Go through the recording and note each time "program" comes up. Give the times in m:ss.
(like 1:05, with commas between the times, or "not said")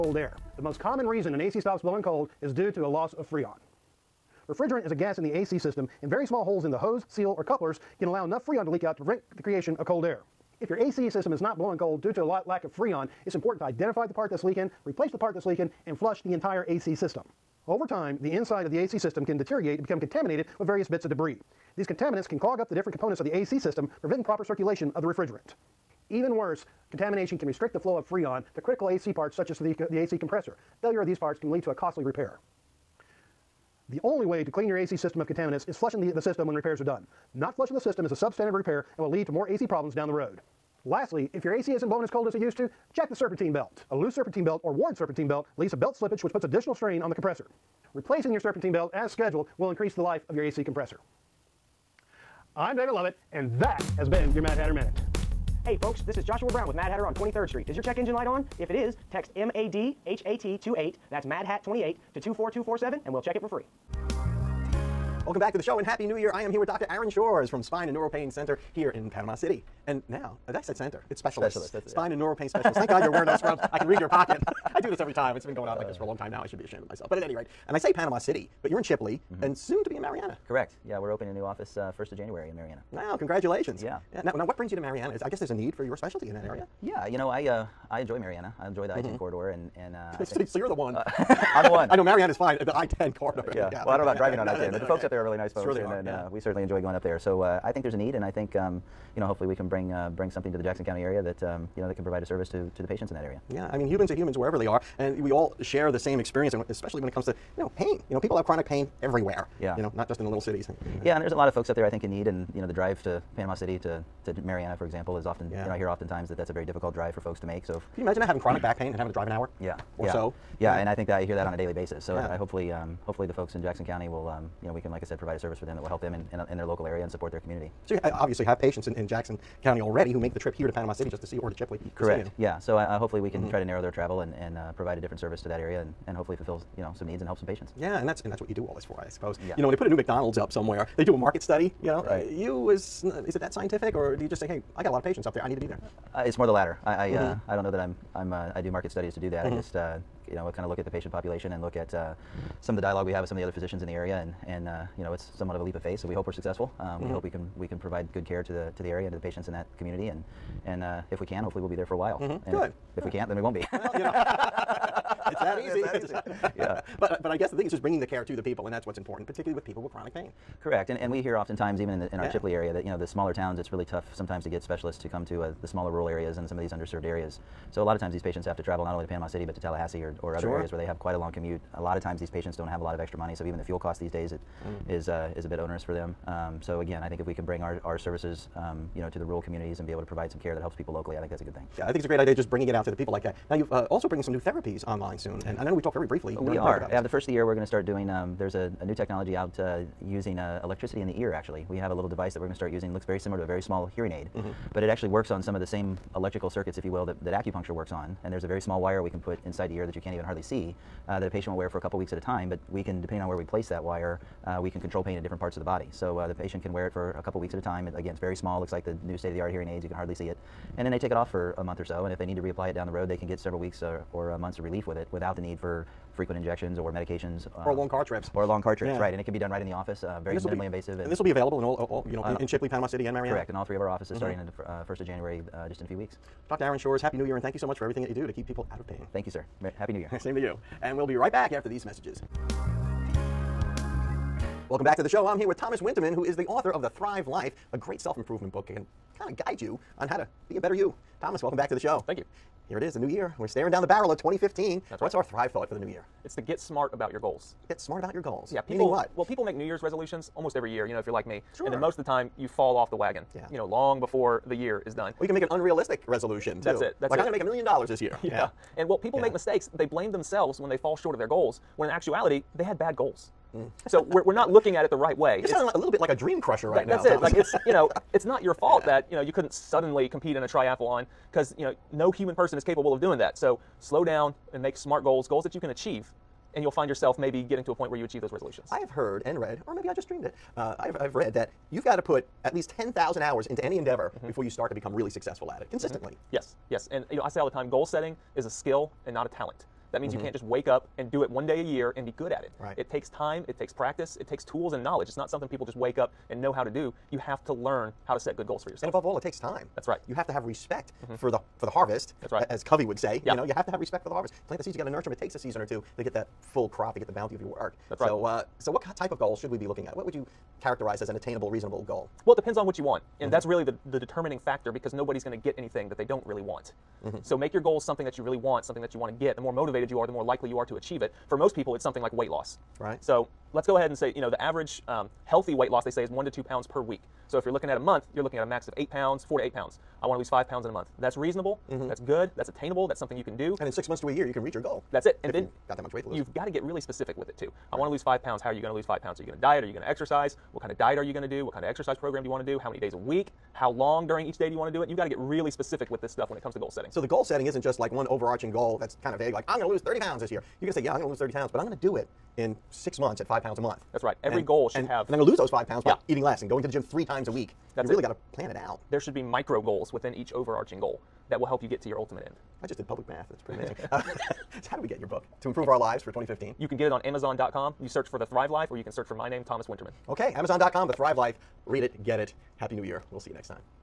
5:51.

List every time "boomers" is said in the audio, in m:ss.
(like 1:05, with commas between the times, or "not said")
not said.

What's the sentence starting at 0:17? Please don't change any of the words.
Over time, the inside of the AC system can deteriorate and become contaminated with various bits of debris.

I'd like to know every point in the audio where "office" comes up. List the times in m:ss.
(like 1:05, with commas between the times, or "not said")
1:21, 3:49, 3:53.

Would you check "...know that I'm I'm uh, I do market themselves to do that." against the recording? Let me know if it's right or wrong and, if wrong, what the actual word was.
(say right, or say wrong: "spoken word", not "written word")
wrong: "studies", not "themselves".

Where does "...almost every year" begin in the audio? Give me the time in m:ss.
4:20.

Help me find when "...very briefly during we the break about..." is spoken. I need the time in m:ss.
3:15.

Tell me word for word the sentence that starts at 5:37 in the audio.
So if you're looking at a month, you're looking at a max of eight pounds, four to eight pounds.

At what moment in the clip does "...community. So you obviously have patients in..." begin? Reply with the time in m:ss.
2:07.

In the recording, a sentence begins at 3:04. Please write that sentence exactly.
is uh, is a bit onerous for them.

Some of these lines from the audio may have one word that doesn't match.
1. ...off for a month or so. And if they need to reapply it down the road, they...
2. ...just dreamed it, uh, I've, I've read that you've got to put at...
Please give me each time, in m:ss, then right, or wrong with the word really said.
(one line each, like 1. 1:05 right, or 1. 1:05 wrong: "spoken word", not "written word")
1. 3:41 right
2. 4:49 right.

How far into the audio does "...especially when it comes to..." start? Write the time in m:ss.
1:46.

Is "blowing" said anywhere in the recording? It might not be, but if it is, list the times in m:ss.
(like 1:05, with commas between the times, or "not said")
0:01, 0:11, 0:41.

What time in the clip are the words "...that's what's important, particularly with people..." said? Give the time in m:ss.
2:48.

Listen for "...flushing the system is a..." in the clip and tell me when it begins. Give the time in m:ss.
0:37.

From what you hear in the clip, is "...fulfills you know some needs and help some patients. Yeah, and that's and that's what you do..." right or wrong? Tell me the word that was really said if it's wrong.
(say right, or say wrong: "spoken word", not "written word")
right.